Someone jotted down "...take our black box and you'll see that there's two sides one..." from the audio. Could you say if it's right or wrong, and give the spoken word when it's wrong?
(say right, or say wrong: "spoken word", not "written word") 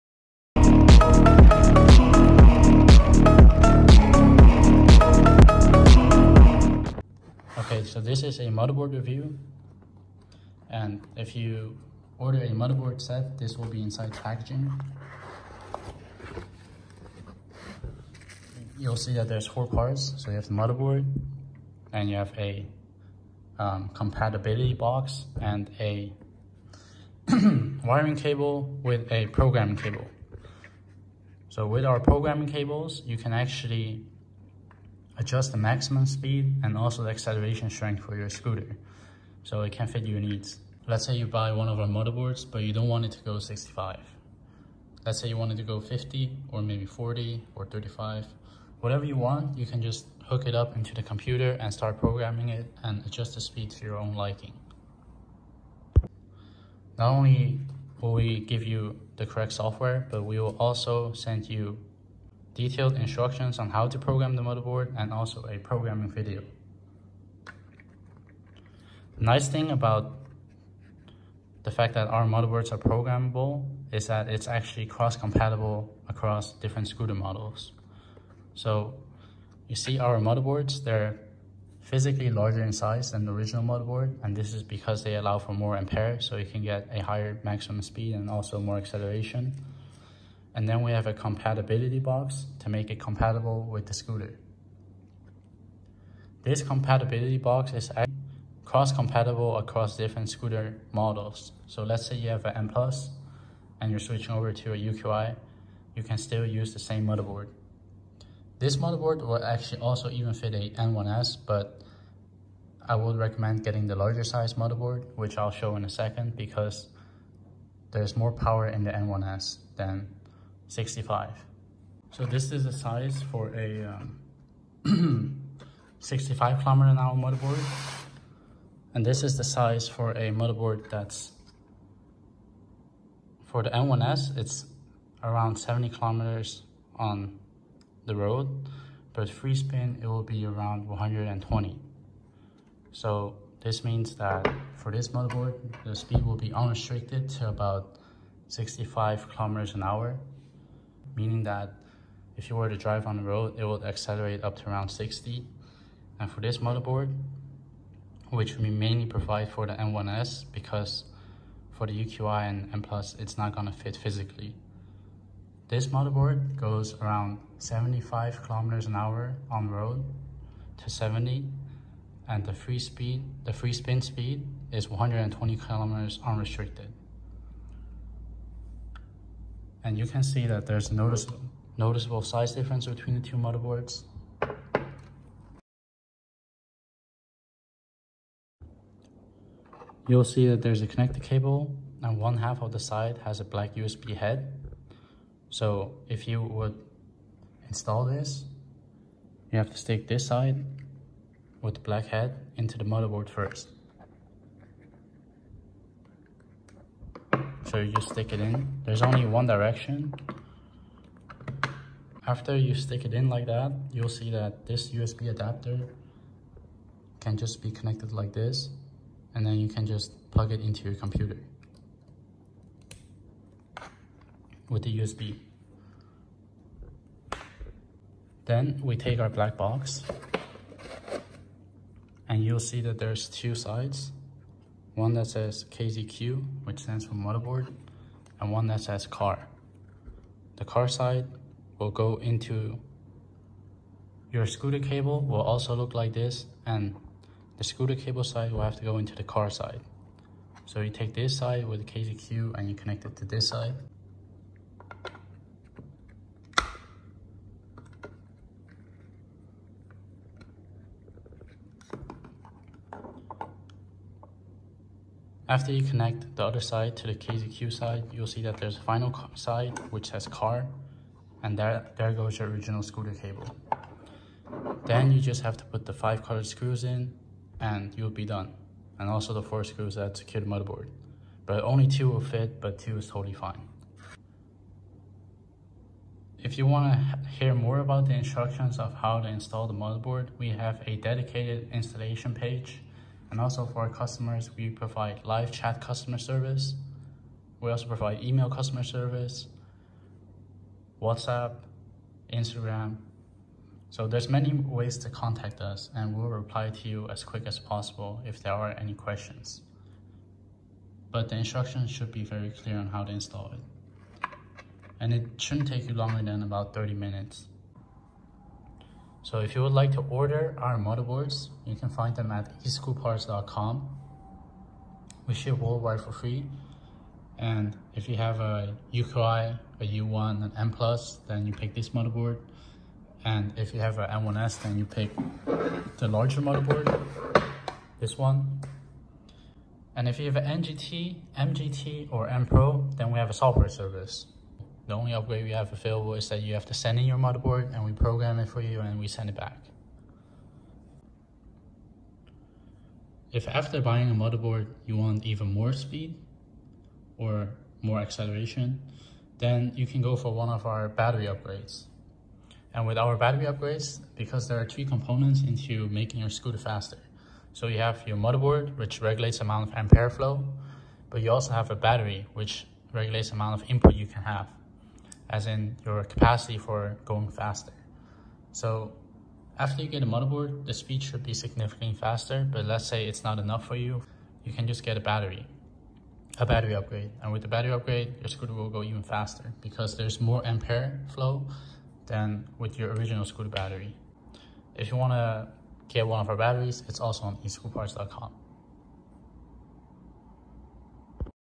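right.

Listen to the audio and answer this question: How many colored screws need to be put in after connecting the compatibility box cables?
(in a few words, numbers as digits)
5.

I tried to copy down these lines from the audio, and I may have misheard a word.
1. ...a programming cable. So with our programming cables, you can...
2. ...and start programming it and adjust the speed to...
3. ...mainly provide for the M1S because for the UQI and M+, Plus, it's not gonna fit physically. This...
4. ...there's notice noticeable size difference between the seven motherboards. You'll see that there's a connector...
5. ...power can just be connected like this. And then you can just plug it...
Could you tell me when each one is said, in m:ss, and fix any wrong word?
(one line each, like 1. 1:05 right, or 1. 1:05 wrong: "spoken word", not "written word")
1. 0:29 right
2. 0:51 right
3. 2:38 right
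4. 3:00 wrong: "two", not "seven"
5. 3:35 wrong: "adapter", not "power".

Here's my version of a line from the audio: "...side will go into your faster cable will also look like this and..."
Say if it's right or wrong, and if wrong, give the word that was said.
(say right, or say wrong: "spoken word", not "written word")
wrong: "scooter", not "faster".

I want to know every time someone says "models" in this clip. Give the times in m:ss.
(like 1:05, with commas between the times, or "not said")
1:17, 1:40.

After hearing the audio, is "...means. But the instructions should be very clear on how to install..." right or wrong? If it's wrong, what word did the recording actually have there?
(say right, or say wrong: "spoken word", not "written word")
wrong: "questions", not "means".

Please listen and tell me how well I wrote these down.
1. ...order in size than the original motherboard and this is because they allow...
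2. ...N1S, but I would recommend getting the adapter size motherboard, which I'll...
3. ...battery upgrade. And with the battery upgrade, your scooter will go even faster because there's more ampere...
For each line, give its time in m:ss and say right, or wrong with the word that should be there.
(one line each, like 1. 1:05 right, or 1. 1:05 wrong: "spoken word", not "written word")
1. 1:22 wrong: "larger", not "order"
2. 1:50 wrong: "larger", not "adapter"
3. 6:26 right.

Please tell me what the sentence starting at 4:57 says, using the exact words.
We also provide email customer service, WhatsApp, Instagram.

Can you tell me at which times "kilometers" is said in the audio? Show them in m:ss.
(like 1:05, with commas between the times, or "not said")
2:06, 2:15, 2:29, 2:48, 2:55.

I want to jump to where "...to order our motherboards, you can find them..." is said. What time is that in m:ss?
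5:19.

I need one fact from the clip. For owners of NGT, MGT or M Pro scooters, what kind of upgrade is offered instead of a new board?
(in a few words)
Software service.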